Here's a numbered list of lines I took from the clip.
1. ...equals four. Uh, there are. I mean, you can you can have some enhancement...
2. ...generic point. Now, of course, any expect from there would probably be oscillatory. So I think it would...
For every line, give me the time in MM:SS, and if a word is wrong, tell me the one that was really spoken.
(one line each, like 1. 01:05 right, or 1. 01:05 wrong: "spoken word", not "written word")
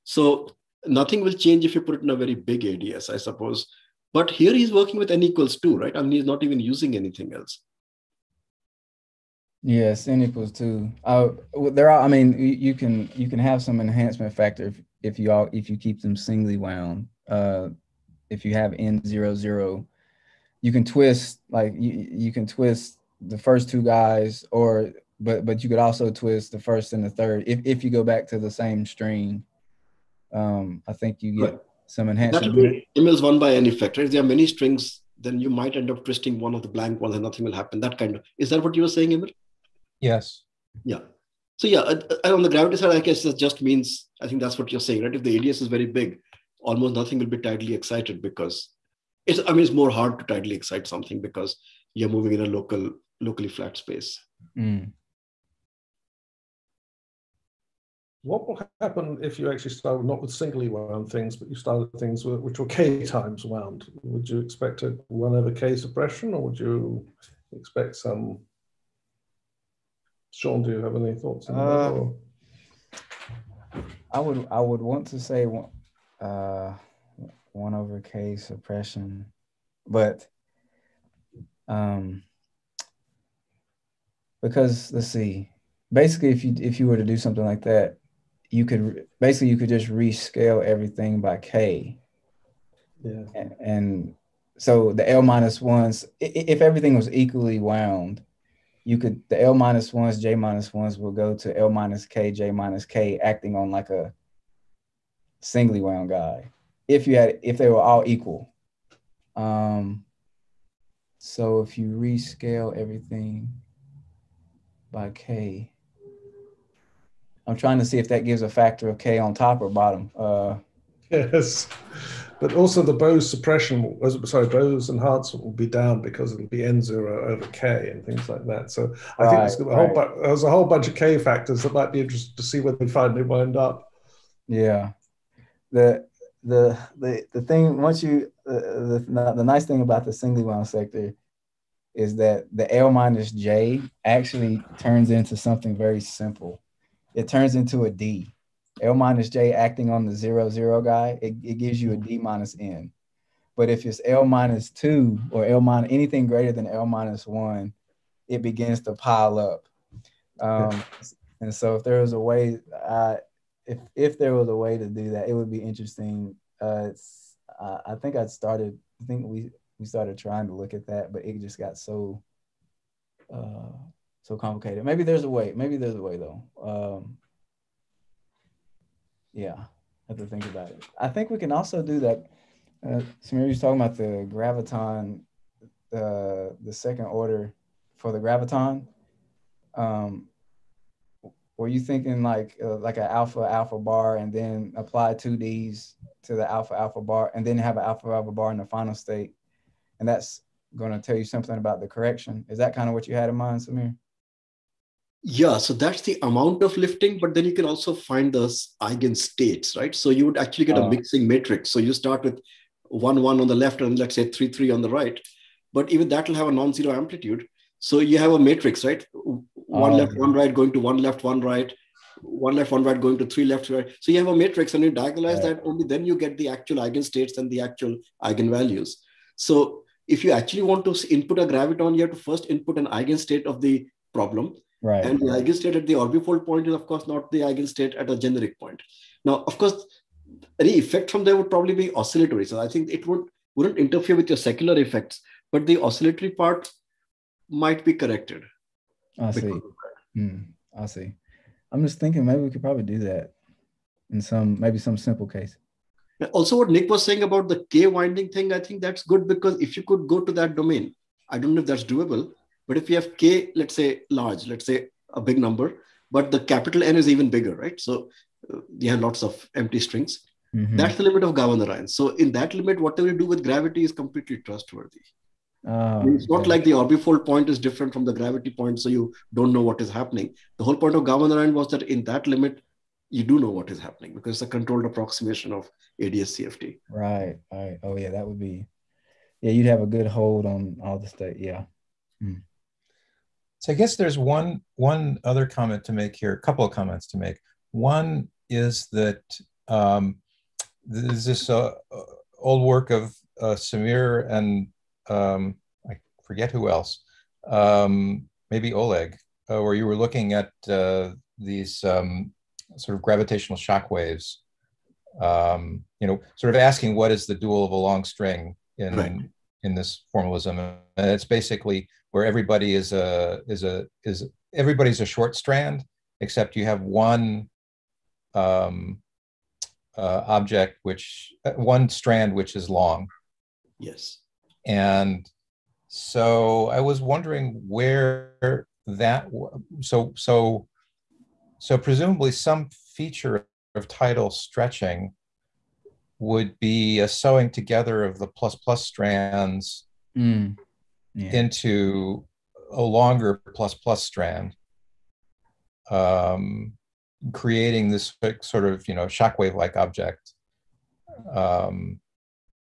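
1. 00:10 wrong: "two", not "four"
2. 03:58 wrong: "effect", not "expect".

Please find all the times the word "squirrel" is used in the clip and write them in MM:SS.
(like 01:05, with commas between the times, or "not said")
not said.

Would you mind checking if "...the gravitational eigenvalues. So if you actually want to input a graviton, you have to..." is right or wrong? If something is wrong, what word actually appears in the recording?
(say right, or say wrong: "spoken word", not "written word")
wrong: "actual", not "gravitational".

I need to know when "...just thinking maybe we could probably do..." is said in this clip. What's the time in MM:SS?
04:11.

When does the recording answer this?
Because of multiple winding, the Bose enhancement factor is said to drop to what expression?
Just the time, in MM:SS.
02:06.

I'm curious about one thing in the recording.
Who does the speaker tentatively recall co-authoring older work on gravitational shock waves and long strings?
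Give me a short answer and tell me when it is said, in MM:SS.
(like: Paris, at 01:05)
Oleg, at 05:08.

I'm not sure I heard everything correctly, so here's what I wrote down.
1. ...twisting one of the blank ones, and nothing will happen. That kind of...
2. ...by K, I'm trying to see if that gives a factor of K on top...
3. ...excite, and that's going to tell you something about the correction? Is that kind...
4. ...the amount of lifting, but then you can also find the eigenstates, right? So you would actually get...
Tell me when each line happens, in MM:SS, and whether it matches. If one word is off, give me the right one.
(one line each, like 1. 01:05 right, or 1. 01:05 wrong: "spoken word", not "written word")
1. 00:36 right
2. 01:54 right
3. 03:18 wrong: "state", not "excite"
4. 03:26 right.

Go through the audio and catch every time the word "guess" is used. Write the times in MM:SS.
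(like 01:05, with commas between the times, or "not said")
00:42, 04:53.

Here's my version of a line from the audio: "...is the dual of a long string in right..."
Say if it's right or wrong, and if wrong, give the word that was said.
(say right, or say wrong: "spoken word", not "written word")
right.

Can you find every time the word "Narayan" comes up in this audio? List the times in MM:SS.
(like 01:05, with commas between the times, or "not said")
04:31, 04:41.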